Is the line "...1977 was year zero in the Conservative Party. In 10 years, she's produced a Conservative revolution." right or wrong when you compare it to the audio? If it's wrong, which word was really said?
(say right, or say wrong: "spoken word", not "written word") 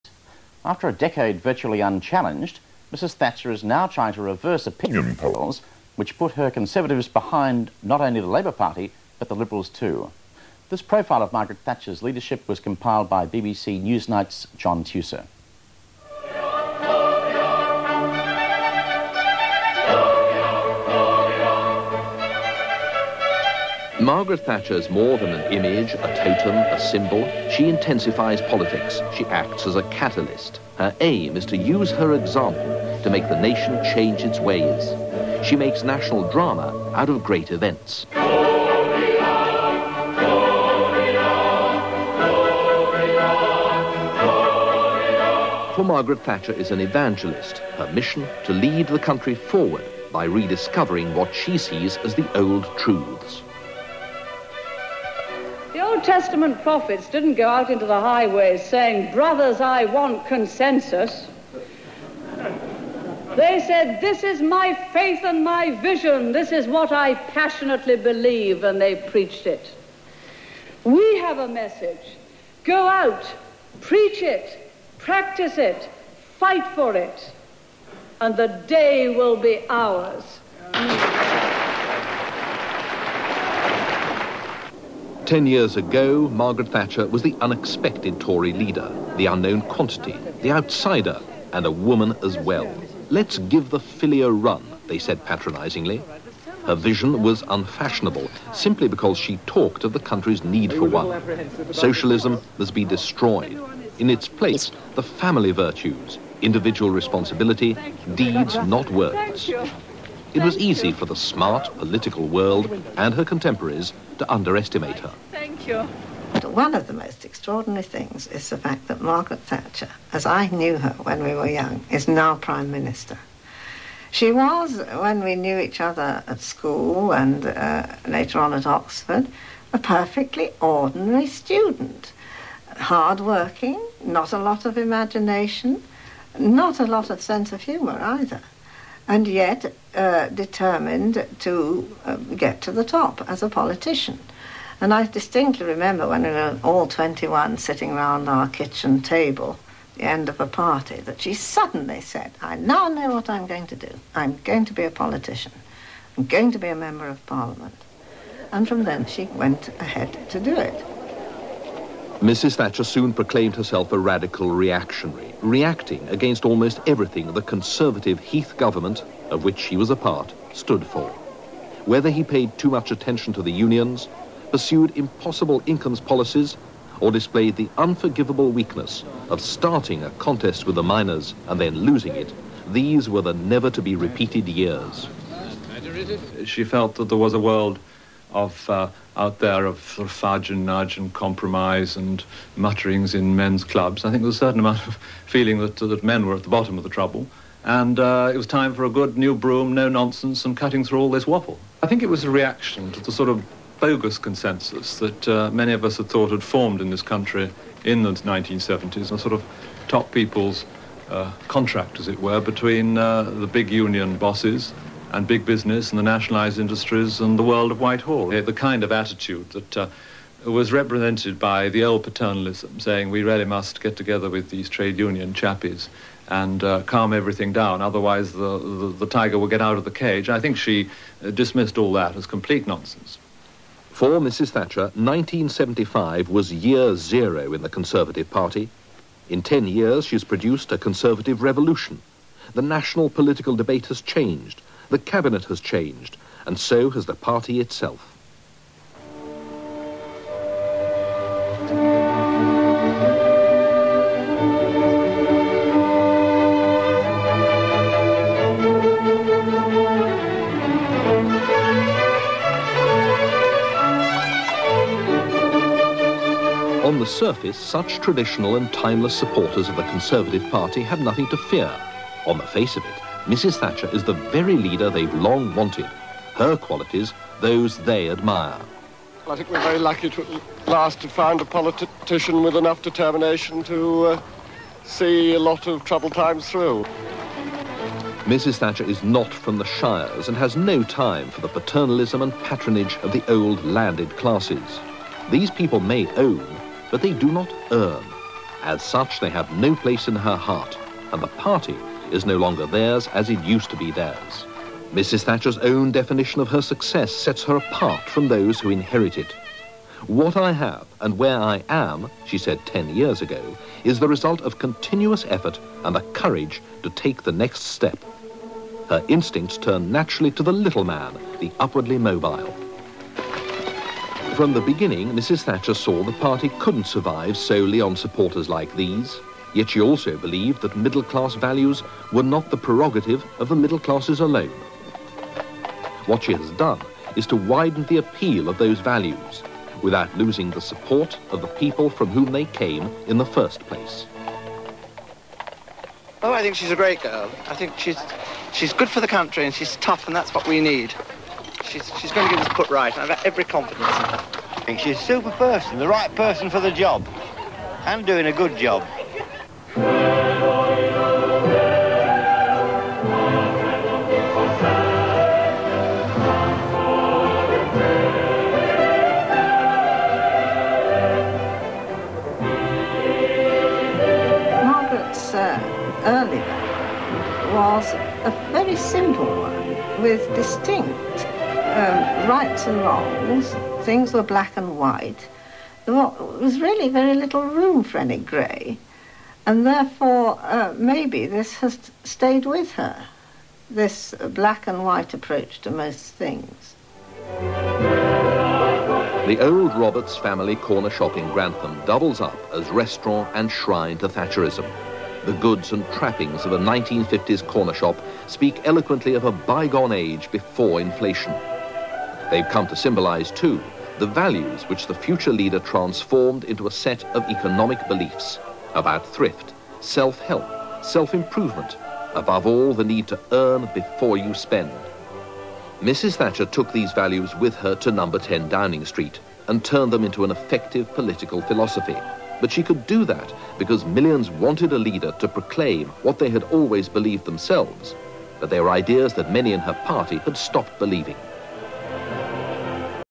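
wrong: "1975", not "1977".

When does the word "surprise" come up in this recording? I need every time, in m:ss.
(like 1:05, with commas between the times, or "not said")
not said.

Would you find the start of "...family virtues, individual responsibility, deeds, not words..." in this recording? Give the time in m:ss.
1:45.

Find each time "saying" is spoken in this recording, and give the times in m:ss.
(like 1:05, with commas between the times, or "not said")
0:58, 3:42.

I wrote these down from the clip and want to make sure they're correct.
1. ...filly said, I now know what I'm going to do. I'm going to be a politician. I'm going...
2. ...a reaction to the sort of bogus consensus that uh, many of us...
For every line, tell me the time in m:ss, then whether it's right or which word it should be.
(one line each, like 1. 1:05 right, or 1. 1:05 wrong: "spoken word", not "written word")
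1. 2:31 wrong: "suddenly", not "filly"
2. 3:22 right.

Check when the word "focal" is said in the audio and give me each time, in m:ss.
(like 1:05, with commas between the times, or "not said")
not said.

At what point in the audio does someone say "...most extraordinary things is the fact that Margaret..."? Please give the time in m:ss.
1:56.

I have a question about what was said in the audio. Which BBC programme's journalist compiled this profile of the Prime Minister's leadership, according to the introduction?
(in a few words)
Newsnight.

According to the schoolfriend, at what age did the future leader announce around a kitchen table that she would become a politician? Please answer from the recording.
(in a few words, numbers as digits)
21.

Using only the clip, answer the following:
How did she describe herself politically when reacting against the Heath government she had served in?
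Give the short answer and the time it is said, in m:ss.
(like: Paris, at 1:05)
radical reactionary, at 2:43.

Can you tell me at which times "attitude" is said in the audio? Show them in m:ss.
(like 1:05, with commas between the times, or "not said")
3:38.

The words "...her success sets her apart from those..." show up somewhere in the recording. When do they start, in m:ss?
5:06.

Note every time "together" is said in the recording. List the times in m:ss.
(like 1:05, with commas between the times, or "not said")
3:43.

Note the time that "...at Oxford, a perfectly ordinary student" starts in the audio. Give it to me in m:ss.
2:08.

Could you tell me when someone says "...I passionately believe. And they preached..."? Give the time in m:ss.
1:06.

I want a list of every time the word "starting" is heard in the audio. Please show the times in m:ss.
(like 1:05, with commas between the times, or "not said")
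2:59.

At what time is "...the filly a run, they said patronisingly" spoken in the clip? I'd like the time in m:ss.
1:33.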